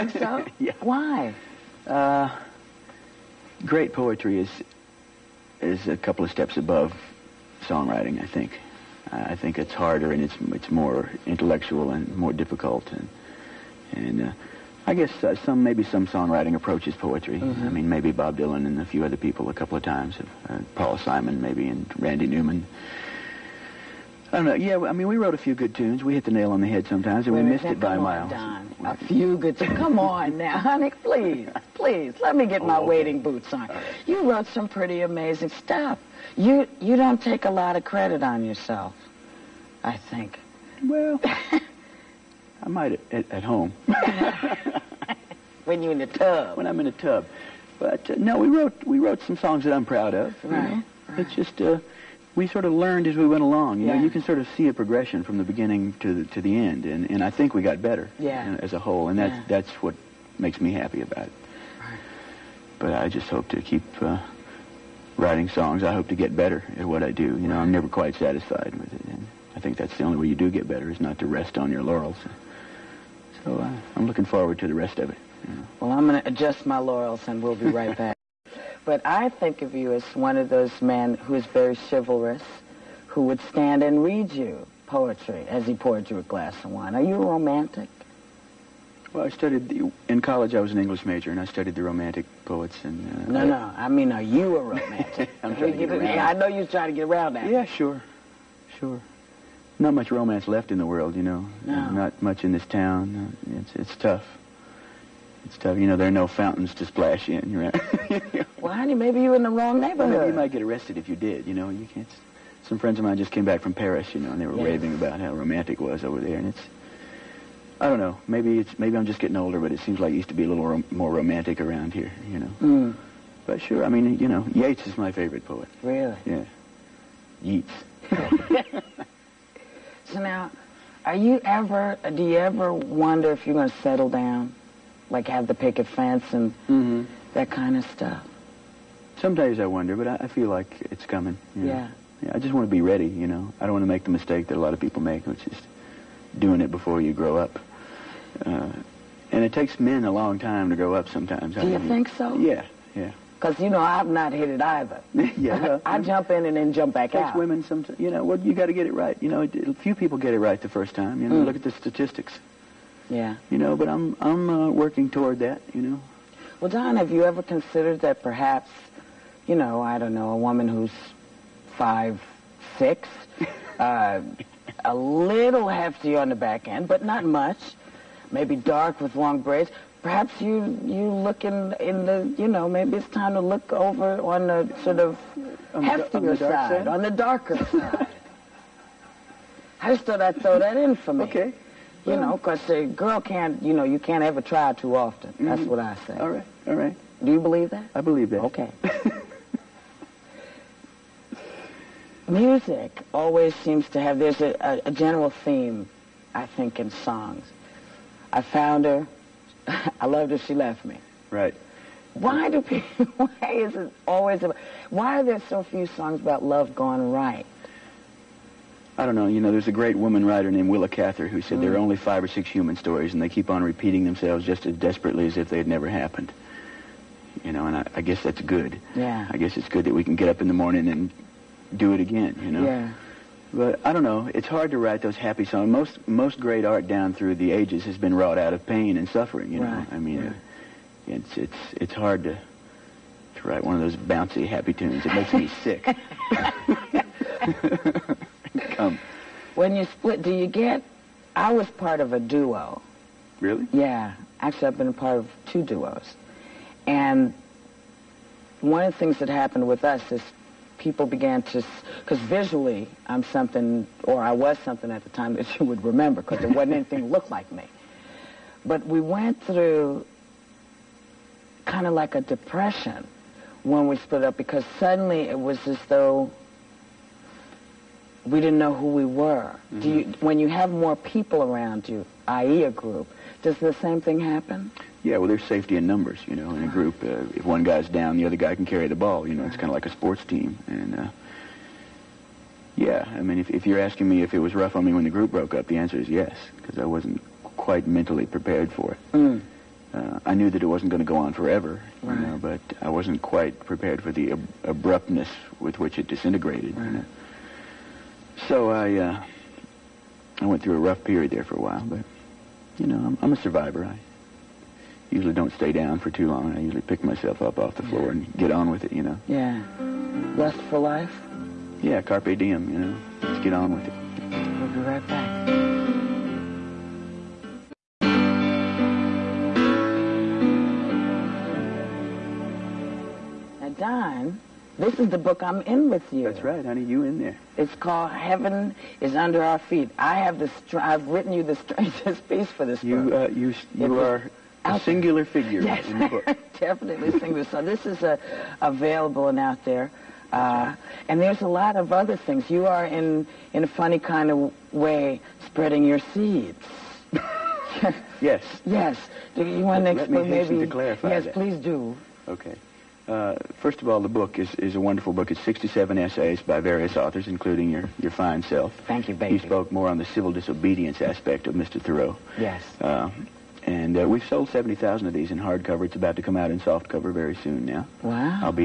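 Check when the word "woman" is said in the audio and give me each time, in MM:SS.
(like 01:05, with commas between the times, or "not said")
02:50, 03:39.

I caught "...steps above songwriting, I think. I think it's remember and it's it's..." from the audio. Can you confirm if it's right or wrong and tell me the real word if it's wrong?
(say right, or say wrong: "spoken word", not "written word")
wrong: "harder", not "remember".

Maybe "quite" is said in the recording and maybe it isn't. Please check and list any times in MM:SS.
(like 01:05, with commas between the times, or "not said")
01:07, 04:57, 05:03.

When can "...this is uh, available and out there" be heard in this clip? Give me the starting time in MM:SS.
05:47.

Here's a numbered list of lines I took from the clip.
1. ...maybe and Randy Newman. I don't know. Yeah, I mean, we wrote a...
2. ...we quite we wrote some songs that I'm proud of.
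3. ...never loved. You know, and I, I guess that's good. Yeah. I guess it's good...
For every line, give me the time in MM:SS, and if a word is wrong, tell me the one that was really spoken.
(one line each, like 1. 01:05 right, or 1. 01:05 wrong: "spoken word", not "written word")
1. 00:21 right
2. 00:48 wrong: "wrote", not "quite"
3. 03:45 wrong: "happened", not "loved".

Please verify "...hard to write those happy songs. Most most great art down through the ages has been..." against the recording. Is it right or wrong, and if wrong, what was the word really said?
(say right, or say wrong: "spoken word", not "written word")
right.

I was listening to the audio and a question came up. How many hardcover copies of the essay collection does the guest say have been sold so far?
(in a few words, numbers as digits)
70,000.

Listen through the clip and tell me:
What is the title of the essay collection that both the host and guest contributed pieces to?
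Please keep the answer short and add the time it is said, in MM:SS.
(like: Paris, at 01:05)
Heaven is Under Our Feet, at 05:38.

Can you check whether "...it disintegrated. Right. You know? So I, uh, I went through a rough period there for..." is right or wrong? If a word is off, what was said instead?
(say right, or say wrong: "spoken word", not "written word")
right.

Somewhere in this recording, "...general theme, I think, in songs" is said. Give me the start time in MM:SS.
03:24.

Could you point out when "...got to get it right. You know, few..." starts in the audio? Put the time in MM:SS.
02:38.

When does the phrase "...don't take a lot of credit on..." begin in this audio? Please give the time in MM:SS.
00:36.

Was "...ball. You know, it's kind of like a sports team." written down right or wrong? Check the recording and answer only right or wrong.
right.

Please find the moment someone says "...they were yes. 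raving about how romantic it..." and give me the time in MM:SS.
01:54.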